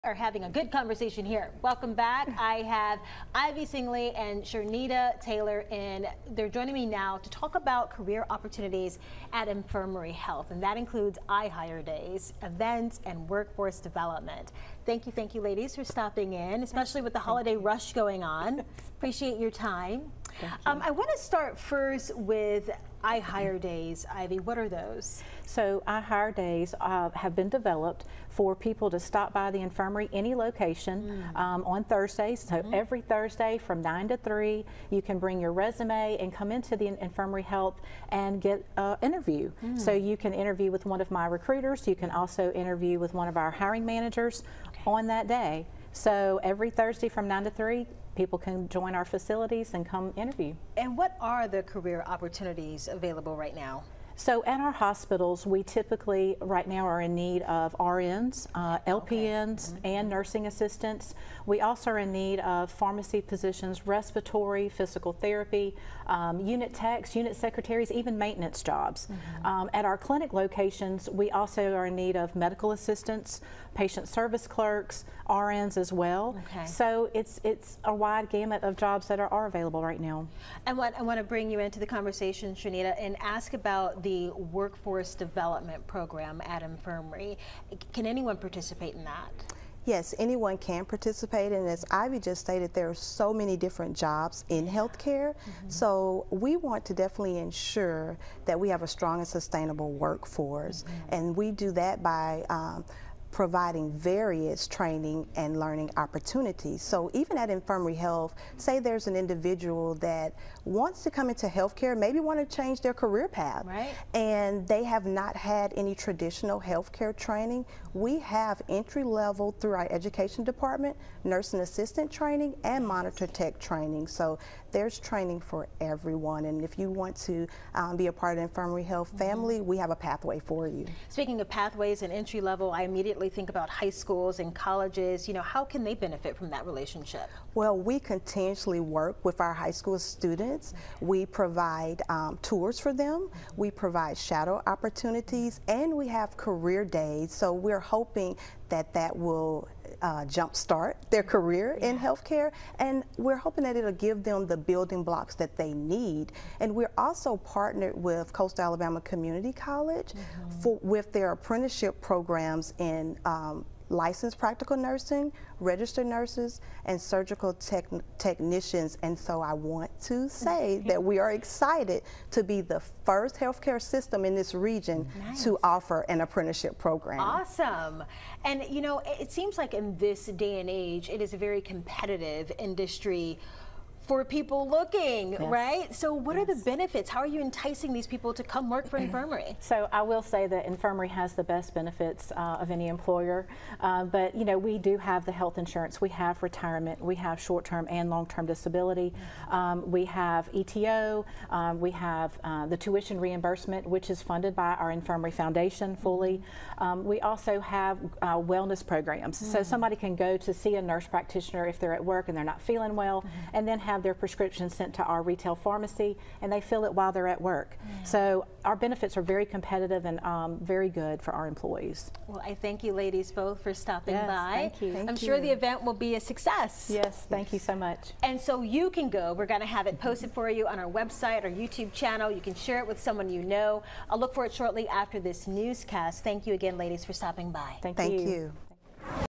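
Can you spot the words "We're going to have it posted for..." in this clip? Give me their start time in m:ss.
3:49.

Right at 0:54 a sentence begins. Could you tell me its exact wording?
So at our hospitals, we typically right now are in need of RNs, uh, LPNs, okay.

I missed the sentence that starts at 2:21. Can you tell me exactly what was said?
We provide um, tours for them.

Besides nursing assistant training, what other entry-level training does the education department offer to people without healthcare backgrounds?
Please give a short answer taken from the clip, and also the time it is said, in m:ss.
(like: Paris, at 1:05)
Monitor tech training, at 2:02.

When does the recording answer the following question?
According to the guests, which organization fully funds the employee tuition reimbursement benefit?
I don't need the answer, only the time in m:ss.
3:24.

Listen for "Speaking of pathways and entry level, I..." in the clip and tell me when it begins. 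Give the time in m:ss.
2:11.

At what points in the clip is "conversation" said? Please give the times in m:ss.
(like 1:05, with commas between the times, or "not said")
0:00, 1:21.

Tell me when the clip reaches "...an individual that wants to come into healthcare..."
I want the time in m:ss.
1:49.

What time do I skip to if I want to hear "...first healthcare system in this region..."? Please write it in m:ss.
2:53.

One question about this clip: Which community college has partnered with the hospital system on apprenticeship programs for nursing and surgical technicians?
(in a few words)
Coastal Alabama Community College.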